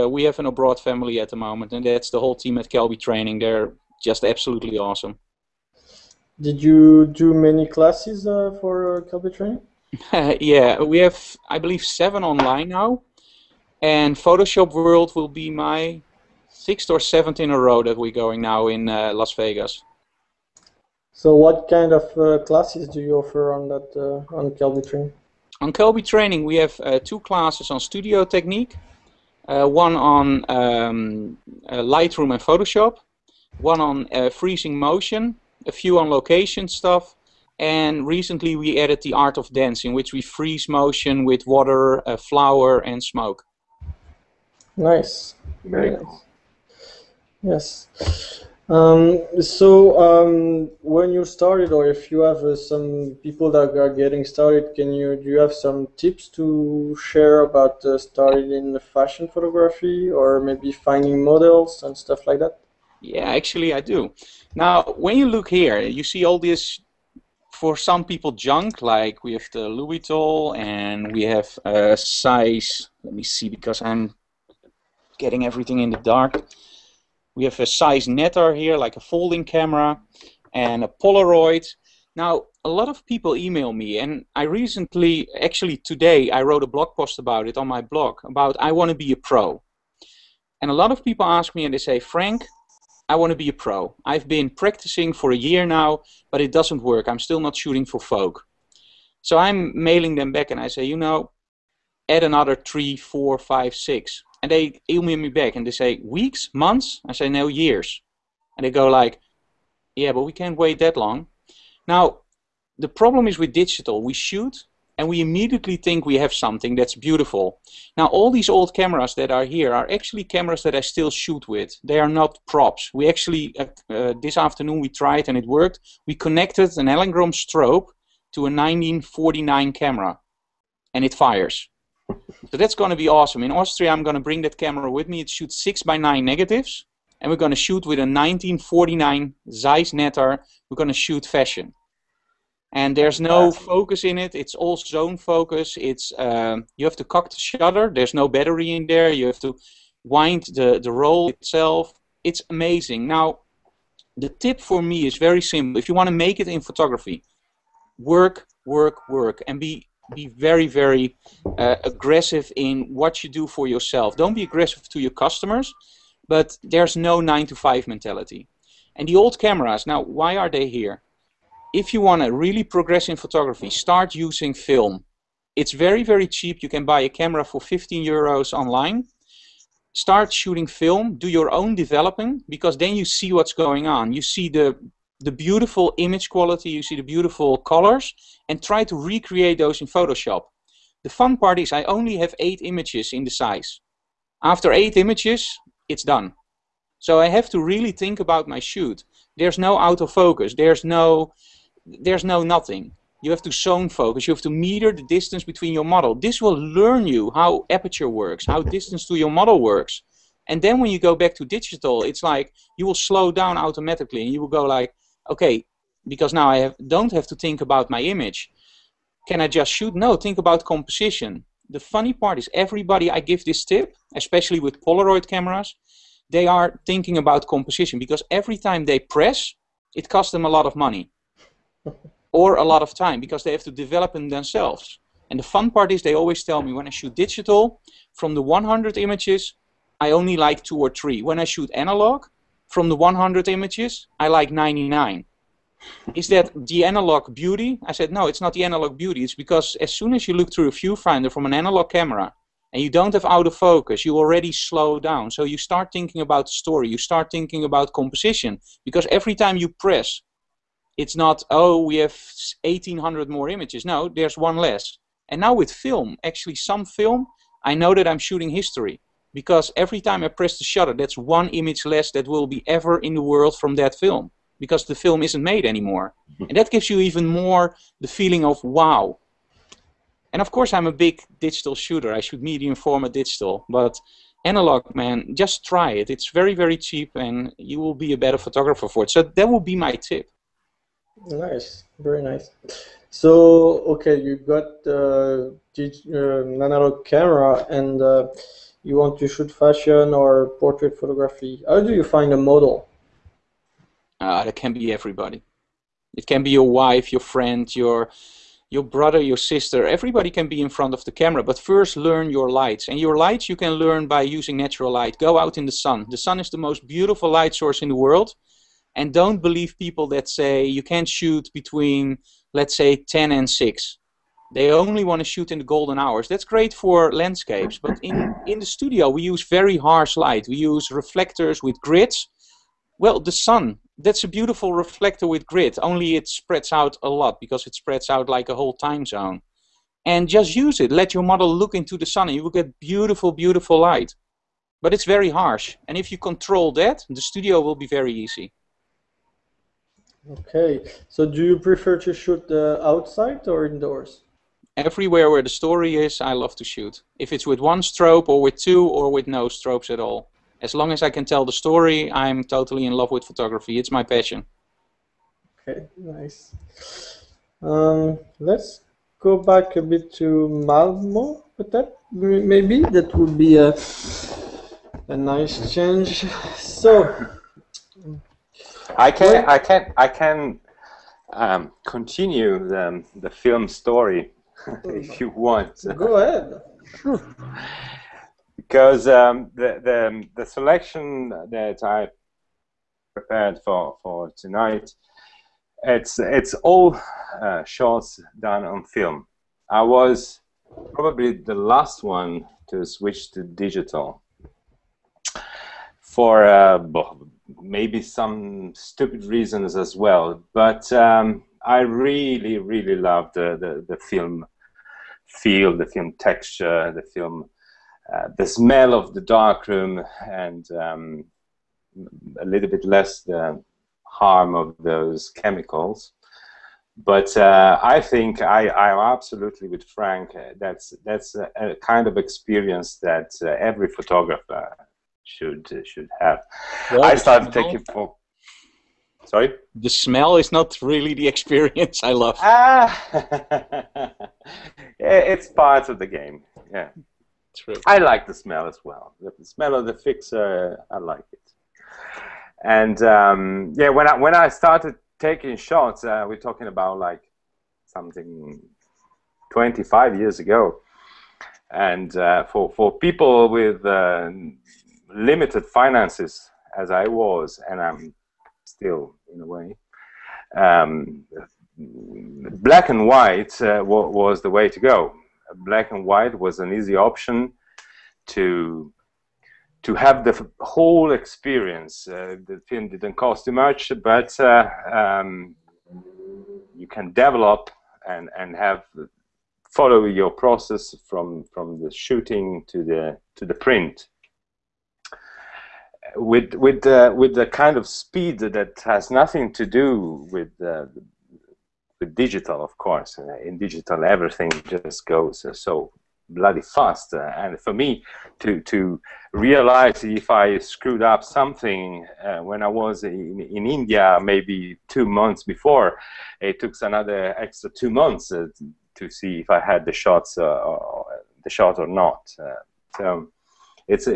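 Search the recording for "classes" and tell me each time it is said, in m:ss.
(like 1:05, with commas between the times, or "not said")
0:07, 0:22, 0:27.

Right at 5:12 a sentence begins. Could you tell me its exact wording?
And your lights you can learn by using natural light.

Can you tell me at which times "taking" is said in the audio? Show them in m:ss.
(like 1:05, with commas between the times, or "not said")
7:17, 7:35.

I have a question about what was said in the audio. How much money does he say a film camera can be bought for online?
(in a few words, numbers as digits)
15 euros.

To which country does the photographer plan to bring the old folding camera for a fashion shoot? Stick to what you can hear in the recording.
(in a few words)
Austria.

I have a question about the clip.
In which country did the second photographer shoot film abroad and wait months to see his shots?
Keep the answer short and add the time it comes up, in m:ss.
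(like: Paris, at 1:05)
India, at 8:33.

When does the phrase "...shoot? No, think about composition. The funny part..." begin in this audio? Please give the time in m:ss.
3:39.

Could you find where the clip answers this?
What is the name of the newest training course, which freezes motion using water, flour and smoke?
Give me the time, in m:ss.
0:39.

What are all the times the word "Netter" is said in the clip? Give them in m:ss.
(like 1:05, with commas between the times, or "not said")
1:18, 2:19.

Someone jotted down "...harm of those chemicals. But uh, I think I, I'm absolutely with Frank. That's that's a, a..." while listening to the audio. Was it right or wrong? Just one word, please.
right.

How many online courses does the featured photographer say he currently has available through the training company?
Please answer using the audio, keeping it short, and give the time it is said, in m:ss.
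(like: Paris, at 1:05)
7, at 0:11.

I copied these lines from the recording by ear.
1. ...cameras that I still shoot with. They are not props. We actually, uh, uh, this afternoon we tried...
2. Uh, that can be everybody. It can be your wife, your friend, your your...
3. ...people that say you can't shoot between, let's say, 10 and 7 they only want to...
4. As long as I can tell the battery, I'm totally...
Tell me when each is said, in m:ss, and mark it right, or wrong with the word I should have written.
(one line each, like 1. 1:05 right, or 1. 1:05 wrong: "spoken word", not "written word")
1. 2:00 right
2. 5:04 right
3. 5:19 wrong: "6", not "7"
4. 6:00 wrong: "story", not "battery".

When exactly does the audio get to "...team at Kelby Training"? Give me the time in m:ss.
0:02.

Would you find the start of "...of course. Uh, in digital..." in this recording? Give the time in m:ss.
8:22.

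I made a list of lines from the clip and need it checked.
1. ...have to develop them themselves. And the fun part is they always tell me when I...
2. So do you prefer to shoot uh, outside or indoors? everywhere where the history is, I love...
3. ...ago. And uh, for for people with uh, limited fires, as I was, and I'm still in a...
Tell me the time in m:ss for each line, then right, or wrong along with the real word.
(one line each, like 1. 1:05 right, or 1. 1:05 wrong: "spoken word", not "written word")
1. 3:53 right
2. 5:51 wrong: "story", not "history"
3. 7:40 wrong: "finances", not "fires".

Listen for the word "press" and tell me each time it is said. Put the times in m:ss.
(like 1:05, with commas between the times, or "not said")
3:48, 4:19, 4:30.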